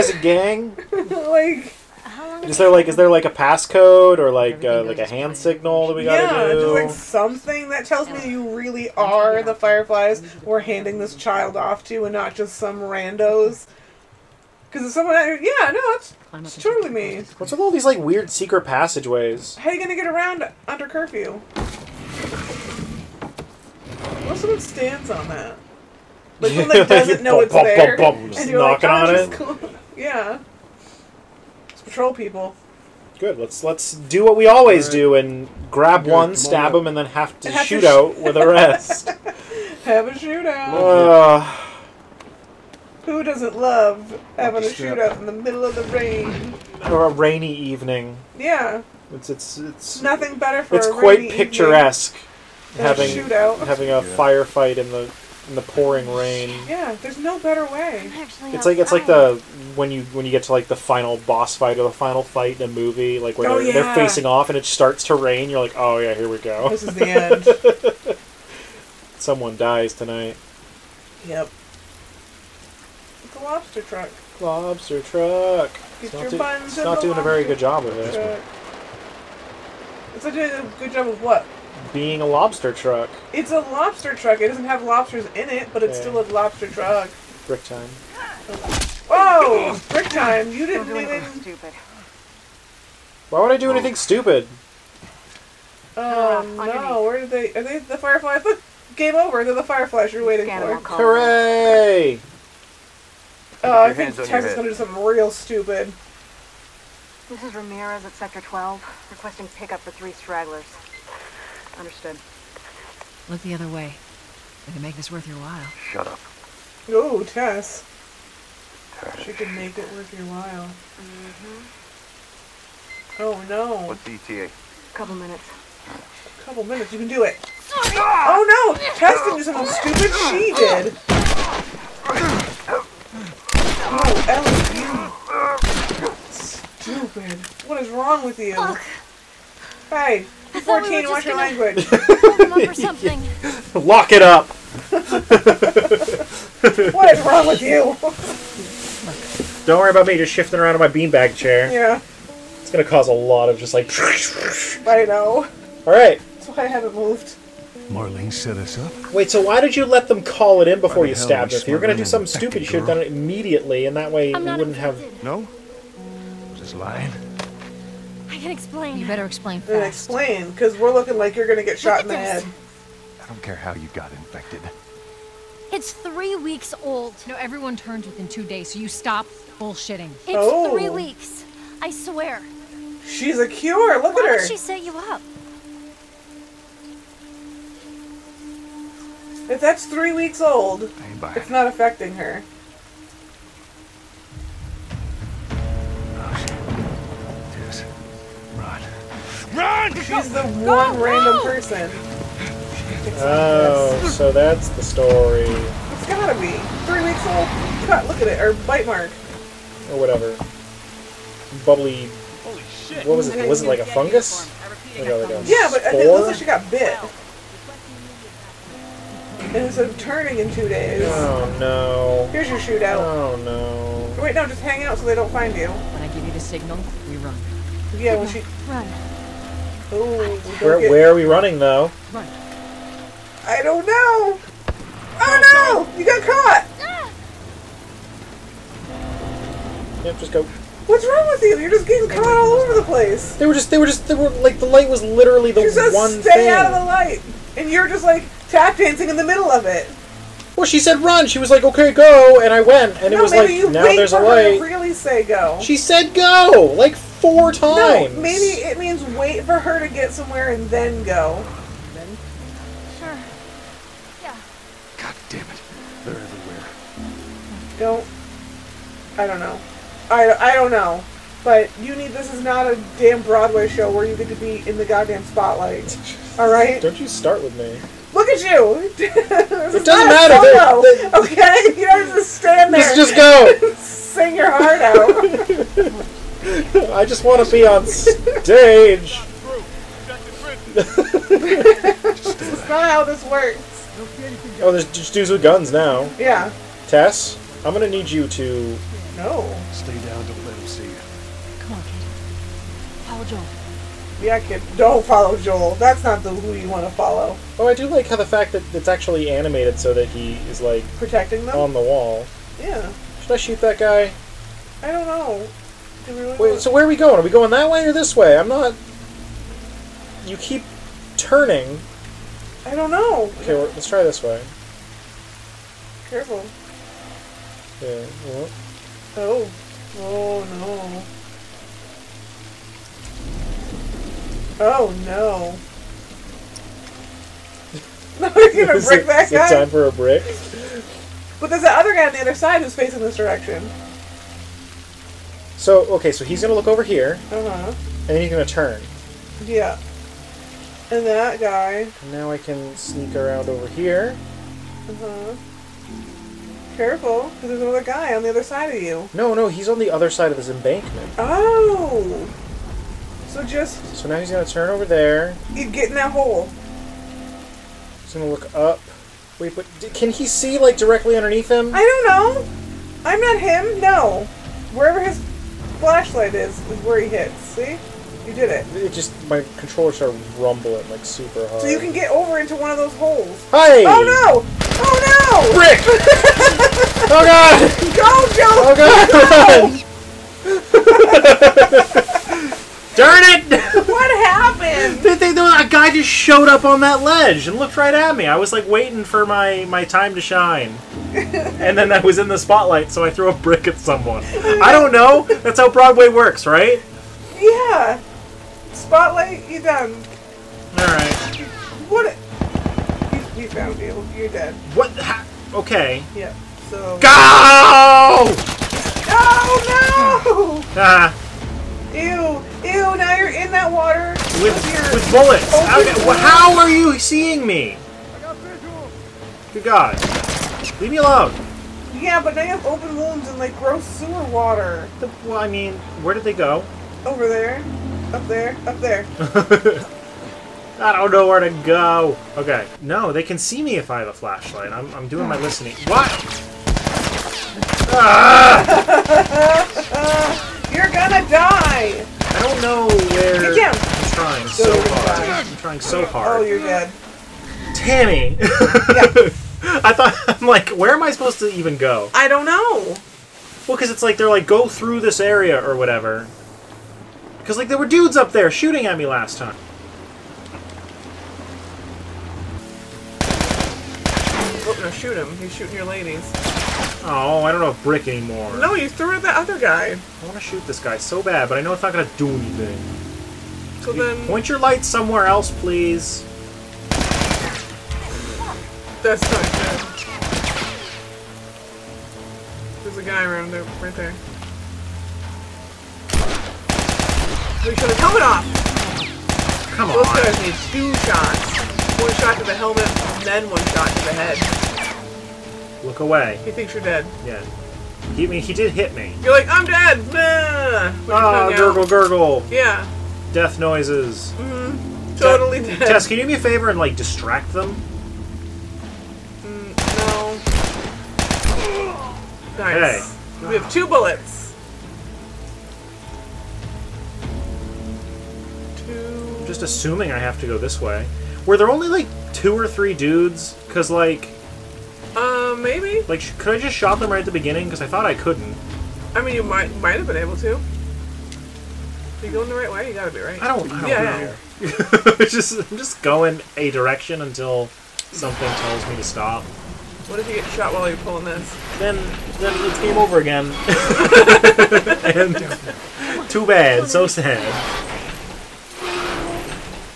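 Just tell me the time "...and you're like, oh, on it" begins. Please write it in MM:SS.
00:28.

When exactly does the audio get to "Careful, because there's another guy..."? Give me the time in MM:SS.
05:56.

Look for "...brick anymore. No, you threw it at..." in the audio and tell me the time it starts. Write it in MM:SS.
07:57.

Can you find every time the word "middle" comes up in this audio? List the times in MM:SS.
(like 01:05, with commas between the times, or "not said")
00:45, 04:09.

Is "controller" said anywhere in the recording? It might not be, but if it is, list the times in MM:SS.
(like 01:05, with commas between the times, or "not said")
06:19.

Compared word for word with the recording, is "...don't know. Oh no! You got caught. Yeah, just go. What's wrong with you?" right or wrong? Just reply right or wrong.
right.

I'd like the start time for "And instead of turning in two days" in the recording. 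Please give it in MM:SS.
03:39.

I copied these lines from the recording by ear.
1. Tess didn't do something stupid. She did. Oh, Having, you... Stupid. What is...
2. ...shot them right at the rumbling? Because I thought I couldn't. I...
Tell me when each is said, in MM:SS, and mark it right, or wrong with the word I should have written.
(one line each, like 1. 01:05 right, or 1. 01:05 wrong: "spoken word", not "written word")
1. 02:08 wrong: "Ellie", not "Having"
2. 08:56 wrong: "beginning", not "rumbling".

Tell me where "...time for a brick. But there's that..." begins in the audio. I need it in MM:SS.
05:39.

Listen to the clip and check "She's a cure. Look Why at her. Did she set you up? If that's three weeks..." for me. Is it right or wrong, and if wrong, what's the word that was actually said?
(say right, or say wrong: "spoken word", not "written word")
right.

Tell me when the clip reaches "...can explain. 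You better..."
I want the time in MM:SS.
02:48.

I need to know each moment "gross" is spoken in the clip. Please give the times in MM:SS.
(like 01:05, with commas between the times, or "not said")
07:13.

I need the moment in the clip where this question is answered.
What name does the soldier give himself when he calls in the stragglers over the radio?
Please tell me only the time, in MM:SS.
01:47.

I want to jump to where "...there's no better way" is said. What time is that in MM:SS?
00:57.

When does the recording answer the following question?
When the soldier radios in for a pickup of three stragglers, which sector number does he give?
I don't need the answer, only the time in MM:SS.
01:48.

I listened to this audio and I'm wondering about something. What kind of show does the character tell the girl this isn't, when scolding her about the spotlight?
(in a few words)
Broadway show.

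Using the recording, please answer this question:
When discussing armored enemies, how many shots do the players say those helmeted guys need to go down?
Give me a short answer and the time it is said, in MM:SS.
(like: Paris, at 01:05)
2, at 08:20.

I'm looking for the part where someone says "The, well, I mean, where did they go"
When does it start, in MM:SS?
07:14.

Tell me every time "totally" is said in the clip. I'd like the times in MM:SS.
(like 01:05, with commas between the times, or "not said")
00:16, 08:35.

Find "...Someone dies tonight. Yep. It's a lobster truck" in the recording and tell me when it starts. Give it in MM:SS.
01:09.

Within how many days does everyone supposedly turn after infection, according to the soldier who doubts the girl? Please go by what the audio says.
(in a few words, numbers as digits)
2 days.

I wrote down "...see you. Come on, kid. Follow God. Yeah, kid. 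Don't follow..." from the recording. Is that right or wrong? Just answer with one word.
wrong.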